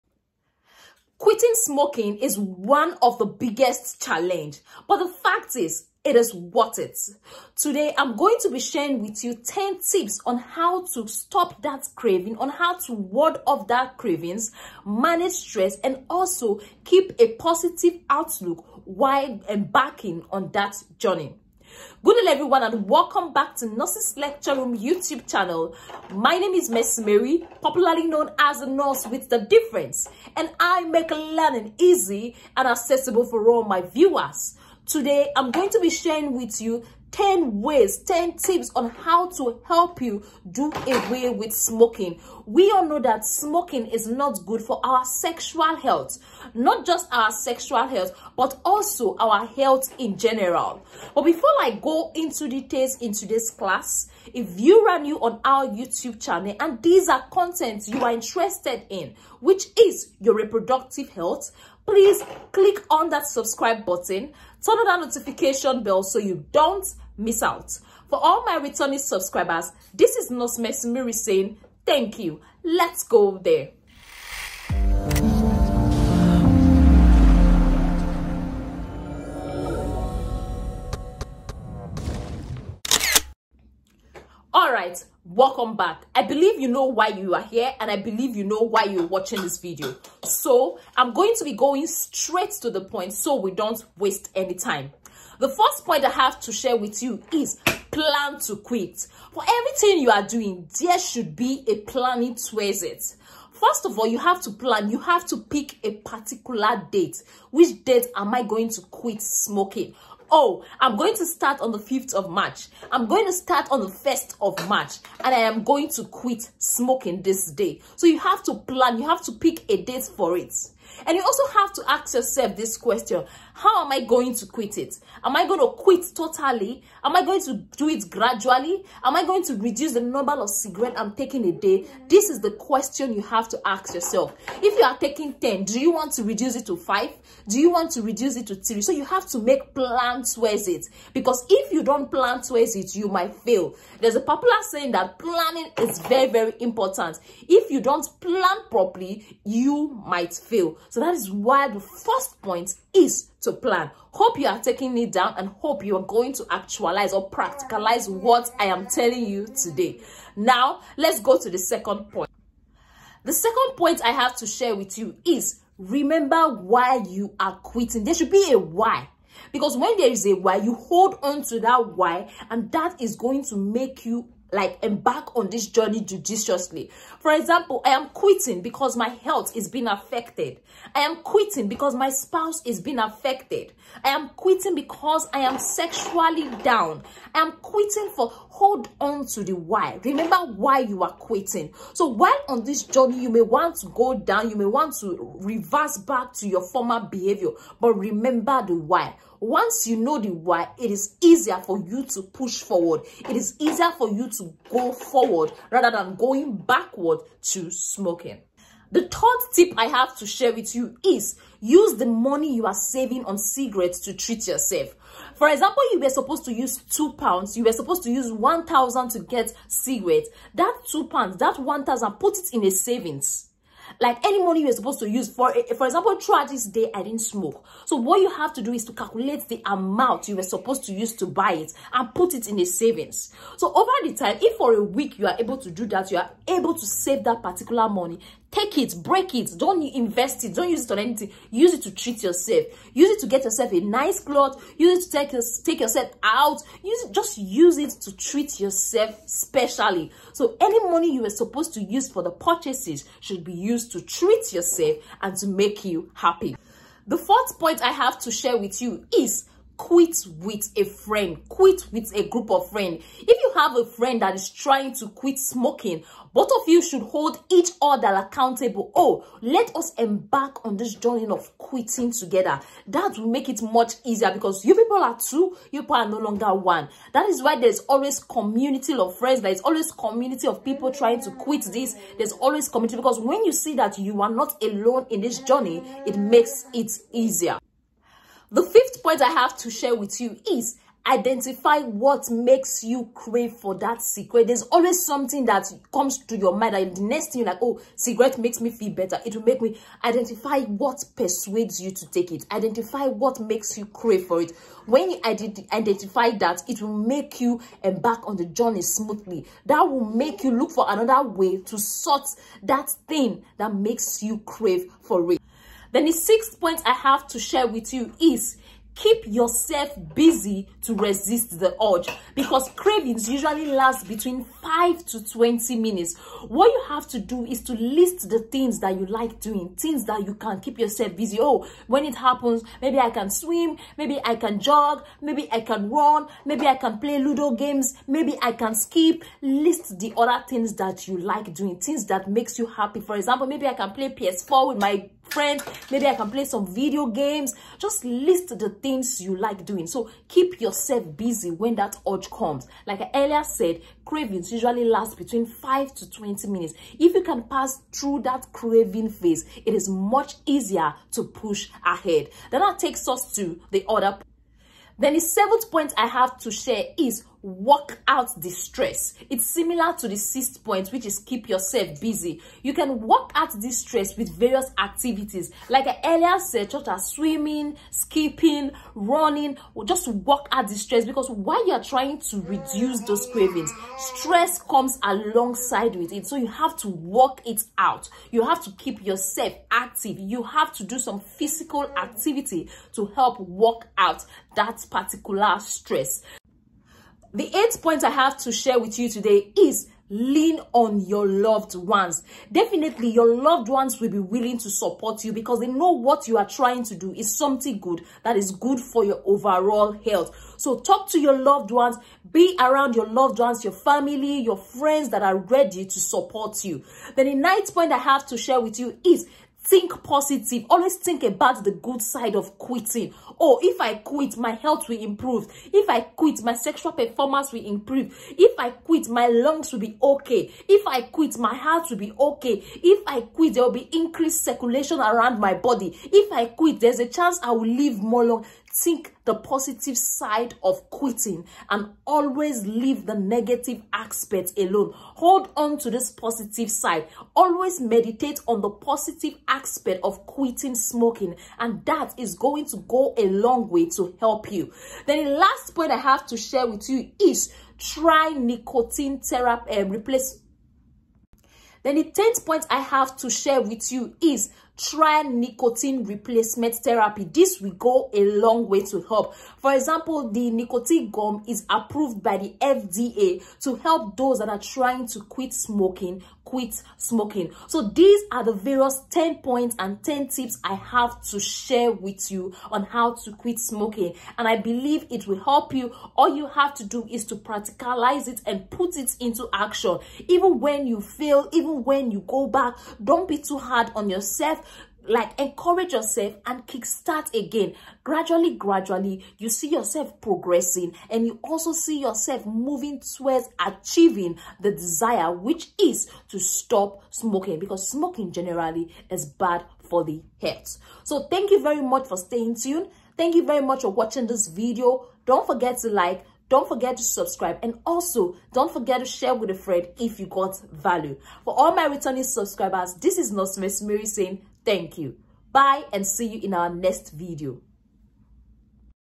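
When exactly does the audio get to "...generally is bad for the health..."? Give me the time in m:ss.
8:28.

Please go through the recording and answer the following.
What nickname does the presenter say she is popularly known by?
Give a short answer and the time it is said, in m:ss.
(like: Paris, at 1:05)
the Nurse with the Difference, at 0:28.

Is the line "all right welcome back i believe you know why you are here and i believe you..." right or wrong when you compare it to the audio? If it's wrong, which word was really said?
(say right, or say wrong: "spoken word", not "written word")
right.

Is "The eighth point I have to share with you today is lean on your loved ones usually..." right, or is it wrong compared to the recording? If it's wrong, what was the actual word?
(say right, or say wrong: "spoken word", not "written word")
wrong: "definitely", not "usually".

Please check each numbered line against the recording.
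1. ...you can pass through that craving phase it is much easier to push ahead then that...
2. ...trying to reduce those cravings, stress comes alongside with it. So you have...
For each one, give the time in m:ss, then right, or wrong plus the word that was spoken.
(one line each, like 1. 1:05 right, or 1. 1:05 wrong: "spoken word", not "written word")
1. 5:57 right
2. 6:21 right.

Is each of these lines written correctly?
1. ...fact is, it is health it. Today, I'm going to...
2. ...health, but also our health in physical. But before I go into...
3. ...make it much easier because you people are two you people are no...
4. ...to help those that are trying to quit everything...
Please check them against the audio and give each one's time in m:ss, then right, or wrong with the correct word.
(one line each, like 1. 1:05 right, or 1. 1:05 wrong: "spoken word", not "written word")
1. 0:05 wrong: "worth", not "health"
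2. 0:47 wrong: "general", not "physical"
3. 4:33 right
4. 7:53 wrong: "smoking", not "everything".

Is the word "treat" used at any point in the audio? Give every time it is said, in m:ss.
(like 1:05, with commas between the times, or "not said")
3:34, 4:01, 4:08, 4:14.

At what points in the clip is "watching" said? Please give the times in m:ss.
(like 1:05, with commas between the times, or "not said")
1:29, 8:33.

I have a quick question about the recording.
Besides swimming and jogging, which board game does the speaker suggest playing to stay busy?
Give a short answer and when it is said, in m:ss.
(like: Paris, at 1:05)
Ludo, at 5:37.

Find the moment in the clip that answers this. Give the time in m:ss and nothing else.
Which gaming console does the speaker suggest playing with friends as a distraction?
5:44.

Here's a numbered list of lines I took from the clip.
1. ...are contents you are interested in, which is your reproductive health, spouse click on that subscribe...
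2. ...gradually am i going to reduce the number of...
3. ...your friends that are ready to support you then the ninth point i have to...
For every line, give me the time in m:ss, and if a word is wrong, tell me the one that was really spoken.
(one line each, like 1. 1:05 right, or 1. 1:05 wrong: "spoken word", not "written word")
1. 0:57 wrong: "please", not "spouse"
2. 2:08 right
3. 6:54 right.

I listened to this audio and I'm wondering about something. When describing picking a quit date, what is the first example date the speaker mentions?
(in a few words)
5th of March.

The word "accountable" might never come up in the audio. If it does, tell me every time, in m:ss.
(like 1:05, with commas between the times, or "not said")
4:28.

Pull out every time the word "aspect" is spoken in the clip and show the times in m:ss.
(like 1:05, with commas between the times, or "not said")
7:23, 7:29.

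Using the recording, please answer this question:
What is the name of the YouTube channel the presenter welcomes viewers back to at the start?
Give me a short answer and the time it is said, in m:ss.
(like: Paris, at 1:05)
Nurses Lecture Room, at 0:23.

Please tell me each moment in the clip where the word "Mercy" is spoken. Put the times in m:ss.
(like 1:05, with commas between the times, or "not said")
1:10.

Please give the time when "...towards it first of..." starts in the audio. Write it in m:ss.
1:42.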